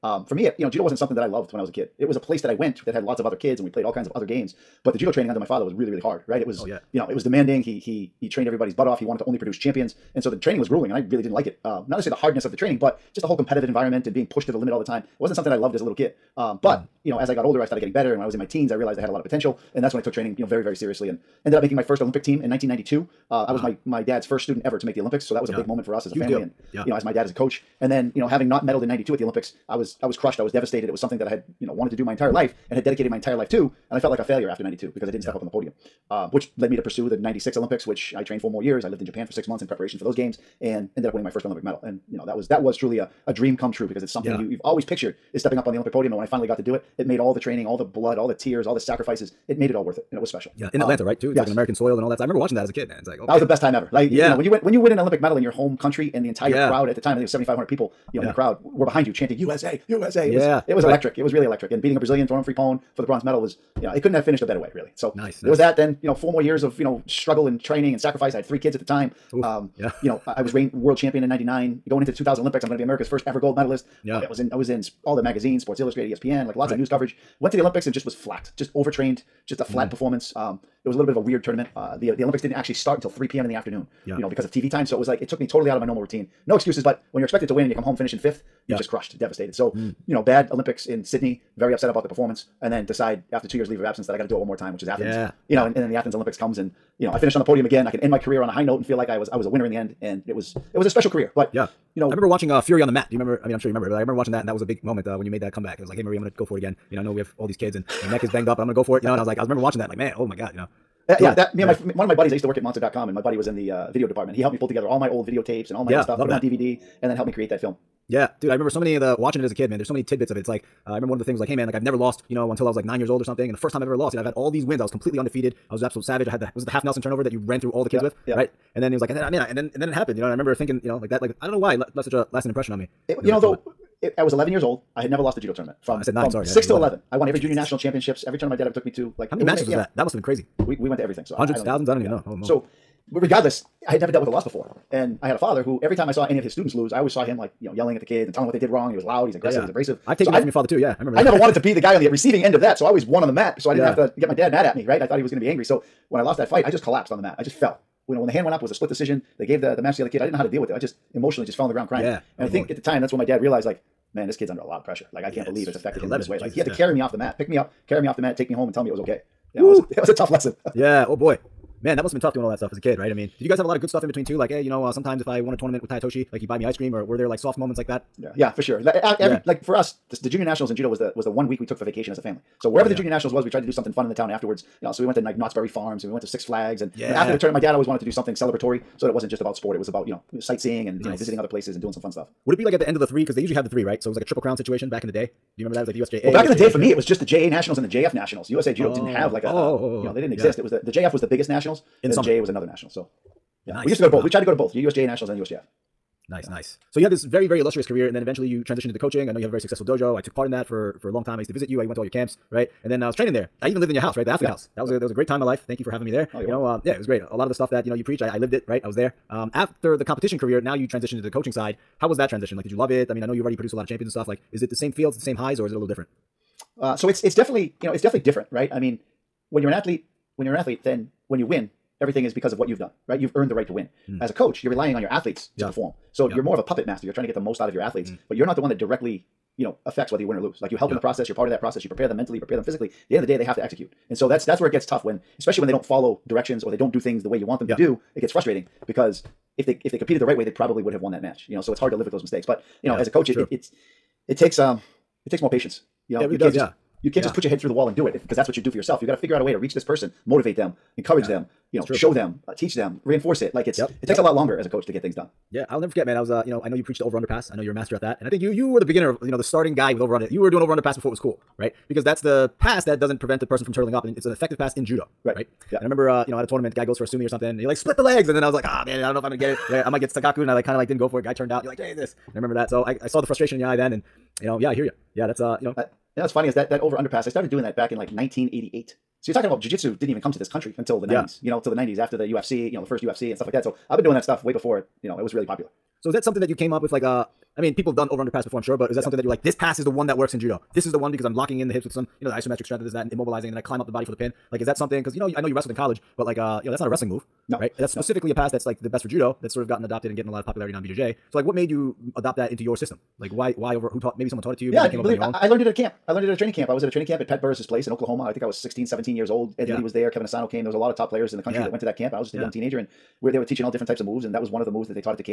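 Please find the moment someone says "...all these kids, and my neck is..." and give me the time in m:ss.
1:47.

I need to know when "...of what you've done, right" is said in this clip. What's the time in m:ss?
3:52.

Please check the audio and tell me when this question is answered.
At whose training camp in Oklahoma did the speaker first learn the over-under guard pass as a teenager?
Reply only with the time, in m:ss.
5:17.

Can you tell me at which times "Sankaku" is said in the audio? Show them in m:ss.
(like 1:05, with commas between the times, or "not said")
4:40.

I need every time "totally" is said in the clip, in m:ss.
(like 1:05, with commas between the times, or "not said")
1:25.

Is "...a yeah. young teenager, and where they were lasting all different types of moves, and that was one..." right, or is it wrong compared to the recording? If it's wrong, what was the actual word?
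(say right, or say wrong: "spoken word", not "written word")
wrong: "teaching", not "lasting".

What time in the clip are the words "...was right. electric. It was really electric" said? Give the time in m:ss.
1:00.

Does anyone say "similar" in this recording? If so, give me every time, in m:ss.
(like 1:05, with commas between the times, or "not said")
not said.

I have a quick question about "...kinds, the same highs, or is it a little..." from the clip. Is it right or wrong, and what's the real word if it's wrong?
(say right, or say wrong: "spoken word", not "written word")
wrong: "fields", not "kinds".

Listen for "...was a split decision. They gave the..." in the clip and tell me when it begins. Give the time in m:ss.
2:38.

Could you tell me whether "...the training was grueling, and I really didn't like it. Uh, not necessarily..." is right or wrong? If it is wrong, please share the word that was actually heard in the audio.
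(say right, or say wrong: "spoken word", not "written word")
right.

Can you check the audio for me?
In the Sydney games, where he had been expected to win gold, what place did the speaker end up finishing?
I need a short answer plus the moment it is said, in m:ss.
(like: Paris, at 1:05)
Fifth, at 1:28.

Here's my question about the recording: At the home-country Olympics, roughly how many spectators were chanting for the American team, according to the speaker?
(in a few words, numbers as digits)
7500.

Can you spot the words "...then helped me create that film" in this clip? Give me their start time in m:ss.
1:57.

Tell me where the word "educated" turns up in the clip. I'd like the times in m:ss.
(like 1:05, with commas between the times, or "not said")
not said.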